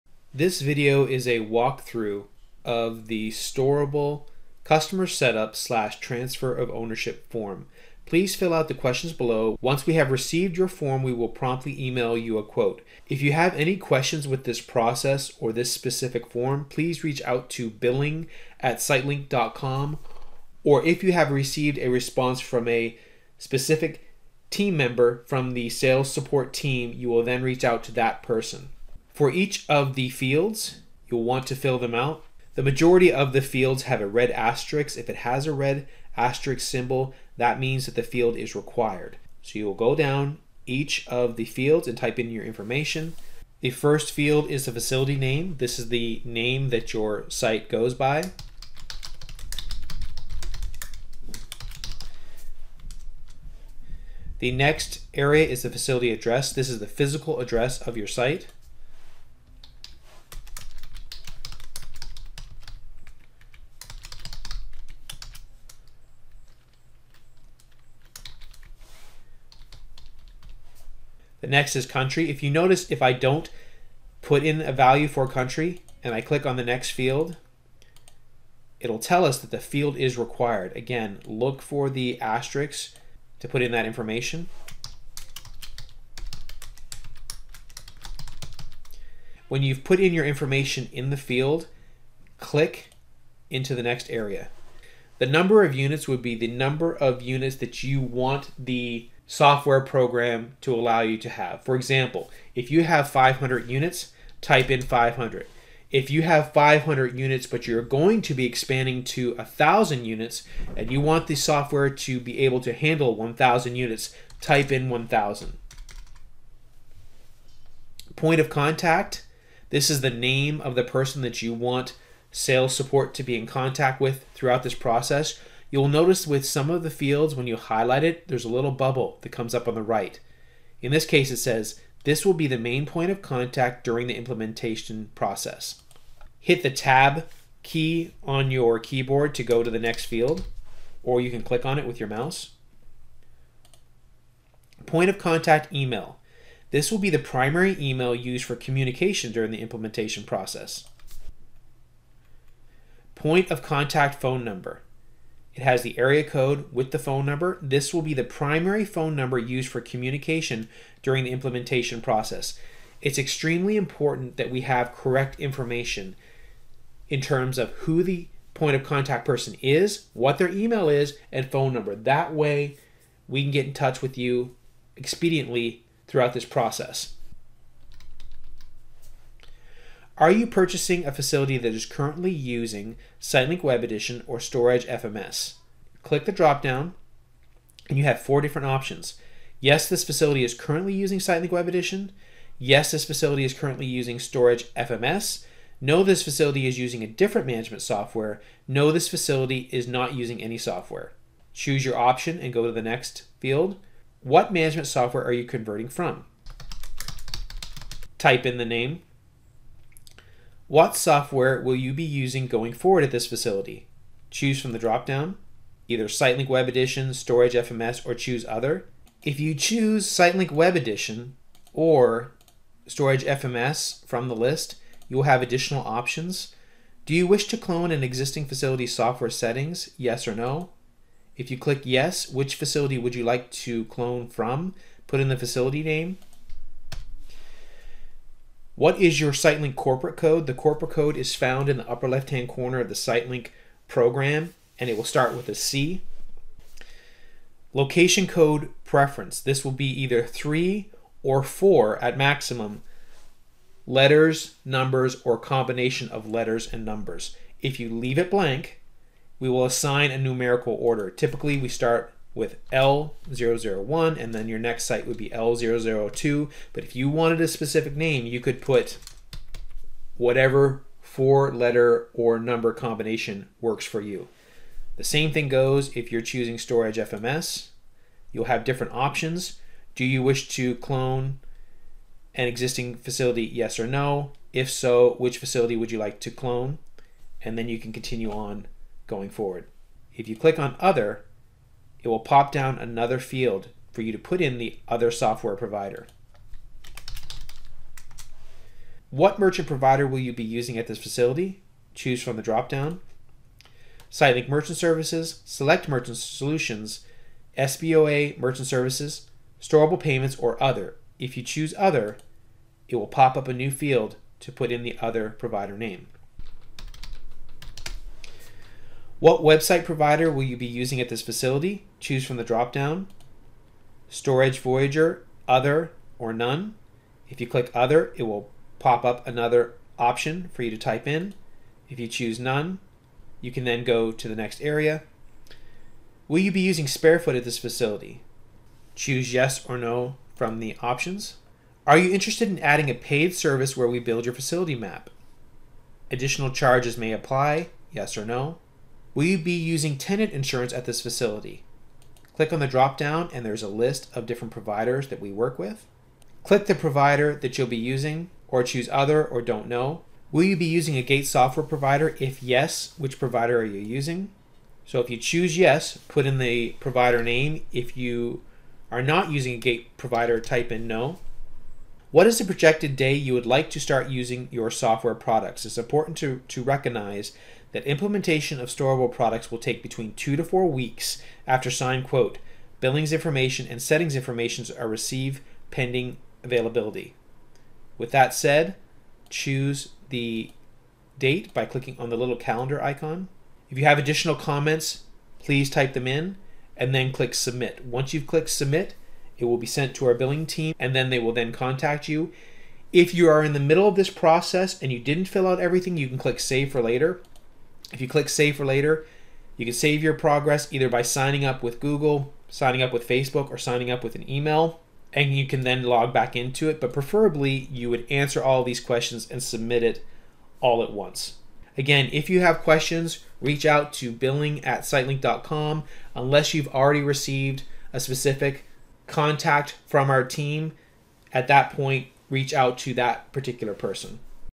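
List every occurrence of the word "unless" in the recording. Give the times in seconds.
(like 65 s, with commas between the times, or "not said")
426 s.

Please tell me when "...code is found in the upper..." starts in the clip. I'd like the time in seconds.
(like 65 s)
240 s.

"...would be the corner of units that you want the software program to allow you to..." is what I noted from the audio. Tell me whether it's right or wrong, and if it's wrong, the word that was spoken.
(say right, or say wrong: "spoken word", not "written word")
wrong: "number", not "corner".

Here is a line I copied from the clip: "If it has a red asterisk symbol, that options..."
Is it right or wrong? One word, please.
wrong.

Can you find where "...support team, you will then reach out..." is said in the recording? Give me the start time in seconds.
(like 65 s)
26 s.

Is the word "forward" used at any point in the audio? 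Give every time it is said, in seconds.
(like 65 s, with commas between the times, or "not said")
212 s, 289 s.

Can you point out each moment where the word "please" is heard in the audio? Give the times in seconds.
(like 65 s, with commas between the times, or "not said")
8 s, 16 s, 395 s.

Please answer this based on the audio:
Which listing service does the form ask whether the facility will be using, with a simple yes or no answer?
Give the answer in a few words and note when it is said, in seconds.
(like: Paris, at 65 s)
Sparefoot, at 336 s.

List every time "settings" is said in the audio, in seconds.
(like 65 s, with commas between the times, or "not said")
229 s, 383 s.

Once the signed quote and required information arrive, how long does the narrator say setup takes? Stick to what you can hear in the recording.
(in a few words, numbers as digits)
2 to 4 weeks.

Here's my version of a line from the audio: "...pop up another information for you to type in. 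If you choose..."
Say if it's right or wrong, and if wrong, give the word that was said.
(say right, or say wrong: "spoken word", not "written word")
wrong: "option", not "information".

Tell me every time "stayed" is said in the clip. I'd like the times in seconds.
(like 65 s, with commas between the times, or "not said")
not said.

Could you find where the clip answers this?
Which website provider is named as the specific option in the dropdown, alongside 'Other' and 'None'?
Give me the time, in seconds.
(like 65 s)
324 s.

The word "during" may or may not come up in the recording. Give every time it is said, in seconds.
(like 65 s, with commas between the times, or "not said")
133 s, 149 s, 161 s.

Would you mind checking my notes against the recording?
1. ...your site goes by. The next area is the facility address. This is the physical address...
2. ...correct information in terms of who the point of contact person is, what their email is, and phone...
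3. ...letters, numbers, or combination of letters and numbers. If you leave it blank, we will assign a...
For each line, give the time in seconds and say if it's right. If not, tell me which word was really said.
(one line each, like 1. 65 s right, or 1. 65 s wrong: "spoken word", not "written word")
1. 46 s right
2. 164 s right
3. 253 s right.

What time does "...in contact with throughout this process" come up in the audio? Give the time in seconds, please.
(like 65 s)
123 s.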